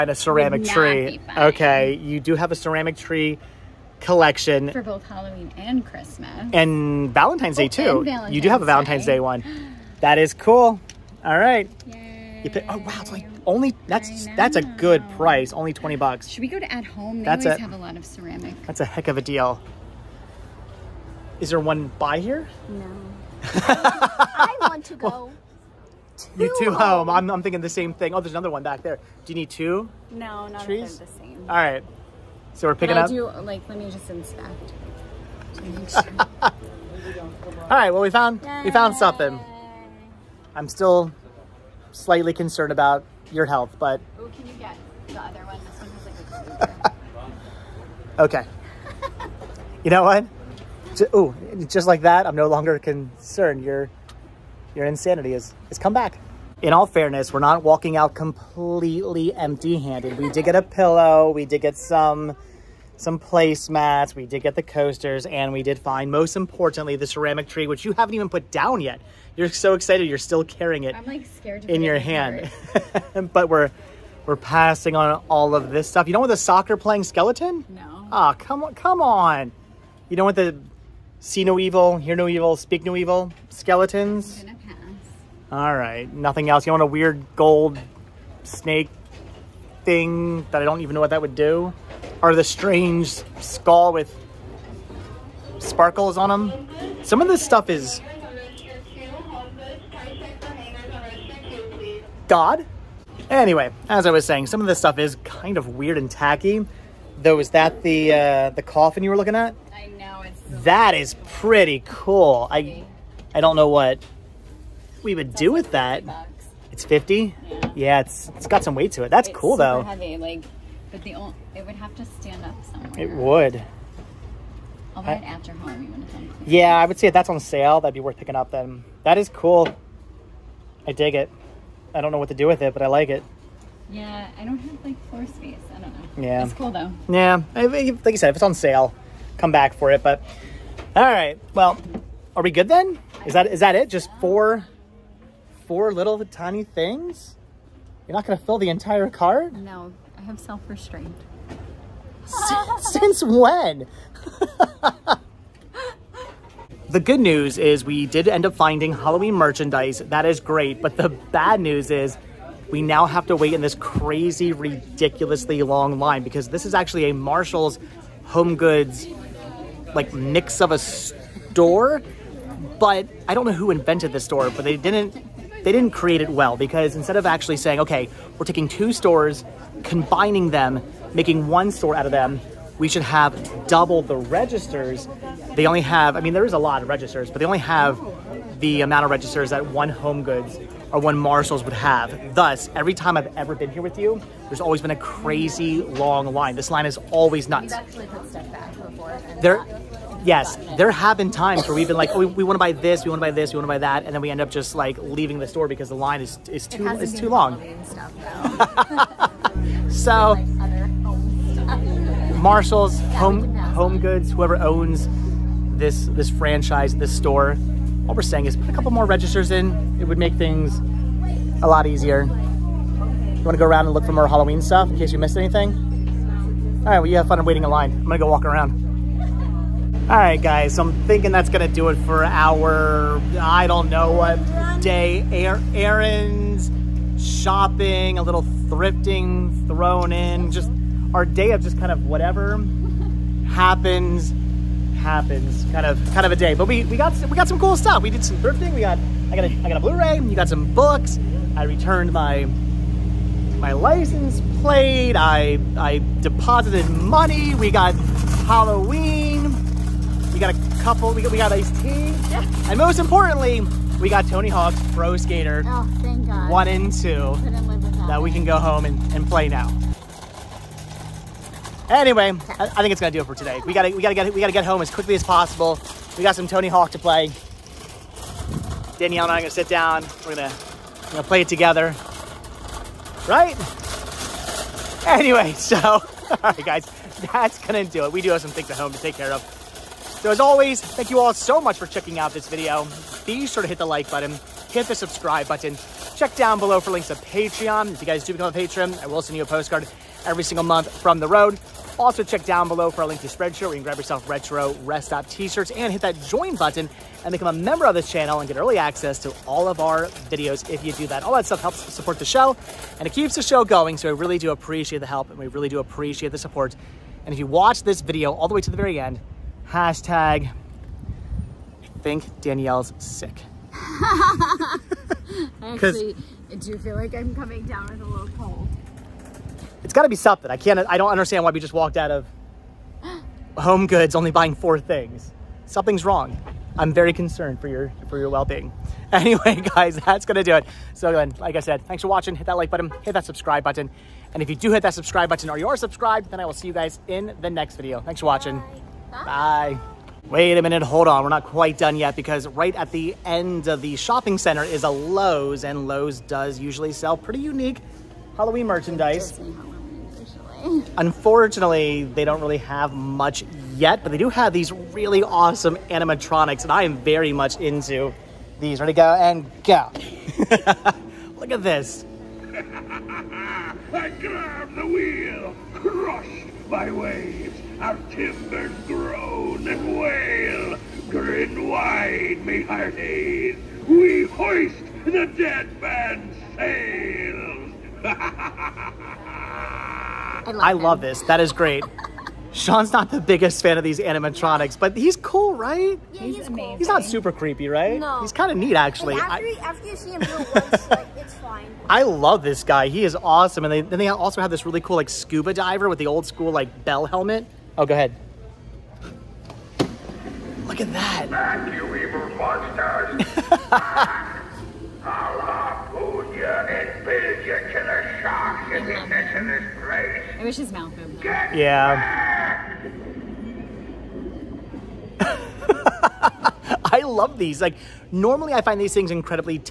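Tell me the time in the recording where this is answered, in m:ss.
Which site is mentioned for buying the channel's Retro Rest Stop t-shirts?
5:03.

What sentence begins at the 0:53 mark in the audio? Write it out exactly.
Your, your insanity is, is come back.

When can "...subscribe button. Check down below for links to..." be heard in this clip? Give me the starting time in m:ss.
4:54.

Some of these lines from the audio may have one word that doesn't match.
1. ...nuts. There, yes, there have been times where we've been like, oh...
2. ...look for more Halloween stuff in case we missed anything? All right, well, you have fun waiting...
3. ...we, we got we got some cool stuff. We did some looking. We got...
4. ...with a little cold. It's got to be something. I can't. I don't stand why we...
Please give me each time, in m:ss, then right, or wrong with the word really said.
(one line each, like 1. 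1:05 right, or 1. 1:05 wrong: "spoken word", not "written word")
1. 3:17 right
2. 3:43 right
3. 4:06 wrong: "thrifting", not "looking"
4. 5:27 wrong: "understand", not "stand".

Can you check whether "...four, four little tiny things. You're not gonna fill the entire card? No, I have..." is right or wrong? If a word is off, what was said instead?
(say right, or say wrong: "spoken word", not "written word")
right.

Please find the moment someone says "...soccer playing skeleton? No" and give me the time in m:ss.
1:16.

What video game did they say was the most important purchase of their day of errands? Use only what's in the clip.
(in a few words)
Tony Hawk's Pro Skater.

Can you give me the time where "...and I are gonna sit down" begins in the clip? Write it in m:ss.
4:39.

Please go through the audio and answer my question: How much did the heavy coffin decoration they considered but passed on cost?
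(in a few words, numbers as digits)
50.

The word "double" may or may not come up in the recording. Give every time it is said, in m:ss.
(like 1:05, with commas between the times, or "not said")
3:03.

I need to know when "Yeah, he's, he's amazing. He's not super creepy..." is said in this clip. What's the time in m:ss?
6:36.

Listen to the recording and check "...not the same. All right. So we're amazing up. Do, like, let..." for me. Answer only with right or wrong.
wrong.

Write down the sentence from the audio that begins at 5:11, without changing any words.
All that stuff helps support the show and it keeps the show going.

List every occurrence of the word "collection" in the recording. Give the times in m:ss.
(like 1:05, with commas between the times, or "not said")
0:03.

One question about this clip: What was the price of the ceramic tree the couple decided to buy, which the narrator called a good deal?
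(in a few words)
$20.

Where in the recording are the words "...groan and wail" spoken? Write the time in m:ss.
6:18.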